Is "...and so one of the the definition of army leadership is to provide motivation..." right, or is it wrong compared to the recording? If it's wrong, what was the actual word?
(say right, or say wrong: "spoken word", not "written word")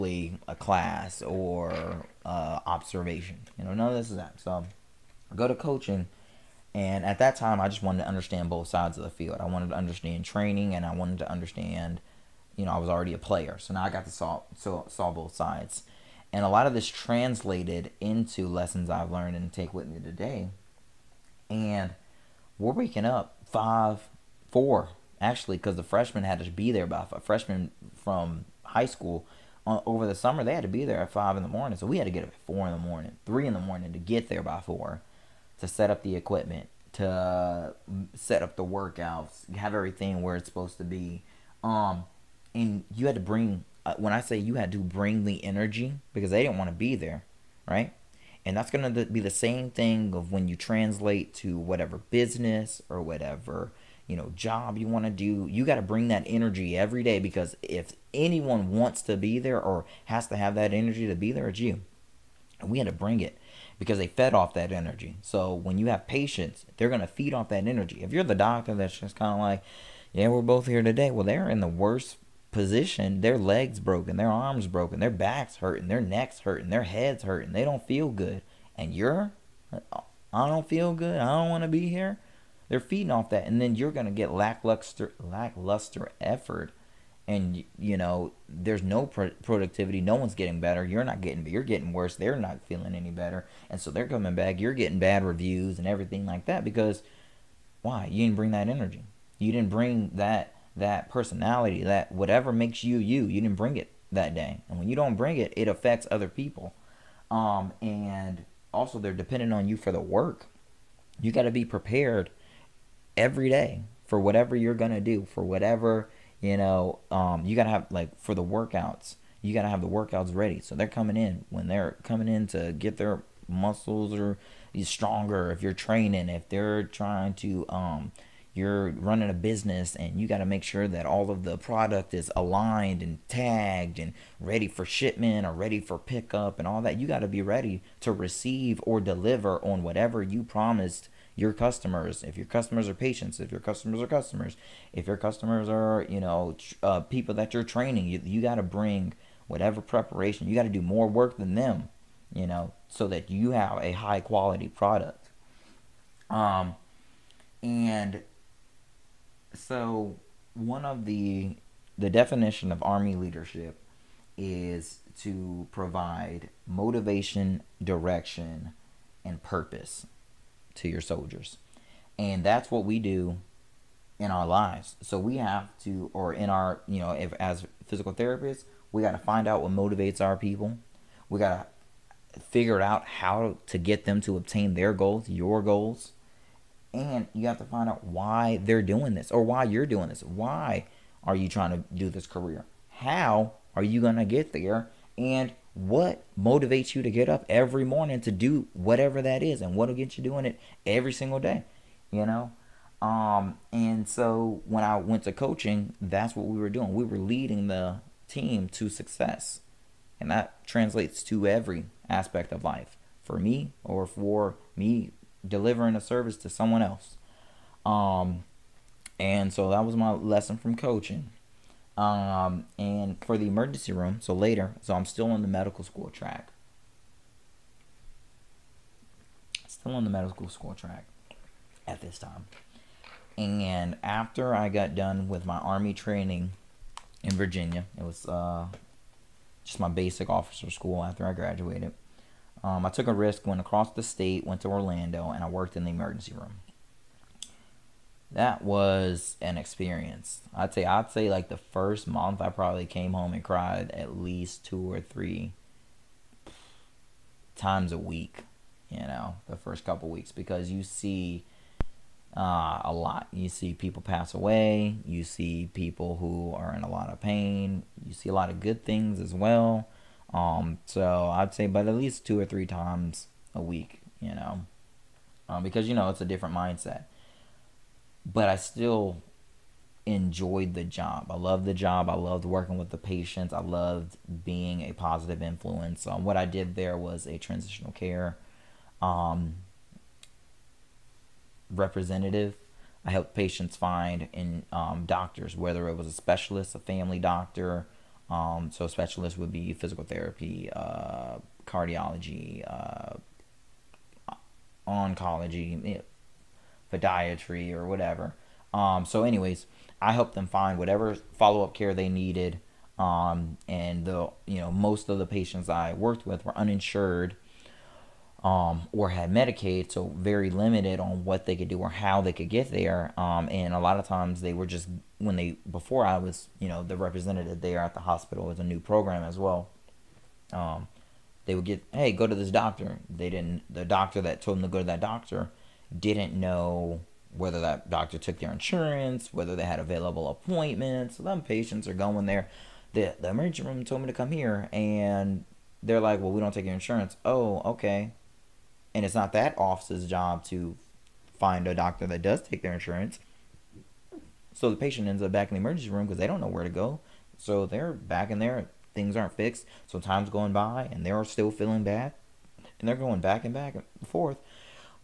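right.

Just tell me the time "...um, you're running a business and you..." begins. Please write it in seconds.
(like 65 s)
127 s.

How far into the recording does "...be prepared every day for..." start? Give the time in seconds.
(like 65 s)
111 s.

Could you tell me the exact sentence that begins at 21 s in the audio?
And we're waking up five, four, actually, because the freshman had to be there by five.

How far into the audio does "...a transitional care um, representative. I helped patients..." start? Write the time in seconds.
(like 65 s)
287 s.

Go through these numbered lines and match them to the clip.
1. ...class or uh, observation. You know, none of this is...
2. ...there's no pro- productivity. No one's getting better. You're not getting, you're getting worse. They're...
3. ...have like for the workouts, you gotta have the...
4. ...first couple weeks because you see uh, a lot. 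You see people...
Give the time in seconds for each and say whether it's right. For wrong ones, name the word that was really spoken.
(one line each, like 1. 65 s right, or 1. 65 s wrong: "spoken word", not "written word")
1. 0 s right
2. 88 s right
3. 117 s right
4. 259 s right.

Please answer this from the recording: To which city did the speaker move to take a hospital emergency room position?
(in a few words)
Orlando.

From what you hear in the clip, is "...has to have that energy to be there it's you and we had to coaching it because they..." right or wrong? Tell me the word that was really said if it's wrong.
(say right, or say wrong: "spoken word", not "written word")
wrong: "bring", not "coaching".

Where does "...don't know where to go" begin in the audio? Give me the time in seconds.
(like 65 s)
356 s.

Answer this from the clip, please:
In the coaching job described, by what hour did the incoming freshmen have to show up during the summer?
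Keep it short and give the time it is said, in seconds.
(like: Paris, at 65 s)
5 in the morning, at 31 s.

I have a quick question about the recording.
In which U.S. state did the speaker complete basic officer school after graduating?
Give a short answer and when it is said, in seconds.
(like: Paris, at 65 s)
Virginia, at 237 s.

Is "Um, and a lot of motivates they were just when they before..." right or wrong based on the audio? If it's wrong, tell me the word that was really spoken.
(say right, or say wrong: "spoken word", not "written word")
wrong: "times", not "motivates".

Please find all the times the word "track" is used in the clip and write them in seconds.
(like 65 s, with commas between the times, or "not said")
226 s, 230 s.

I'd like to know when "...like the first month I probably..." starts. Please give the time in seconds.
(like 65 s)
251 s.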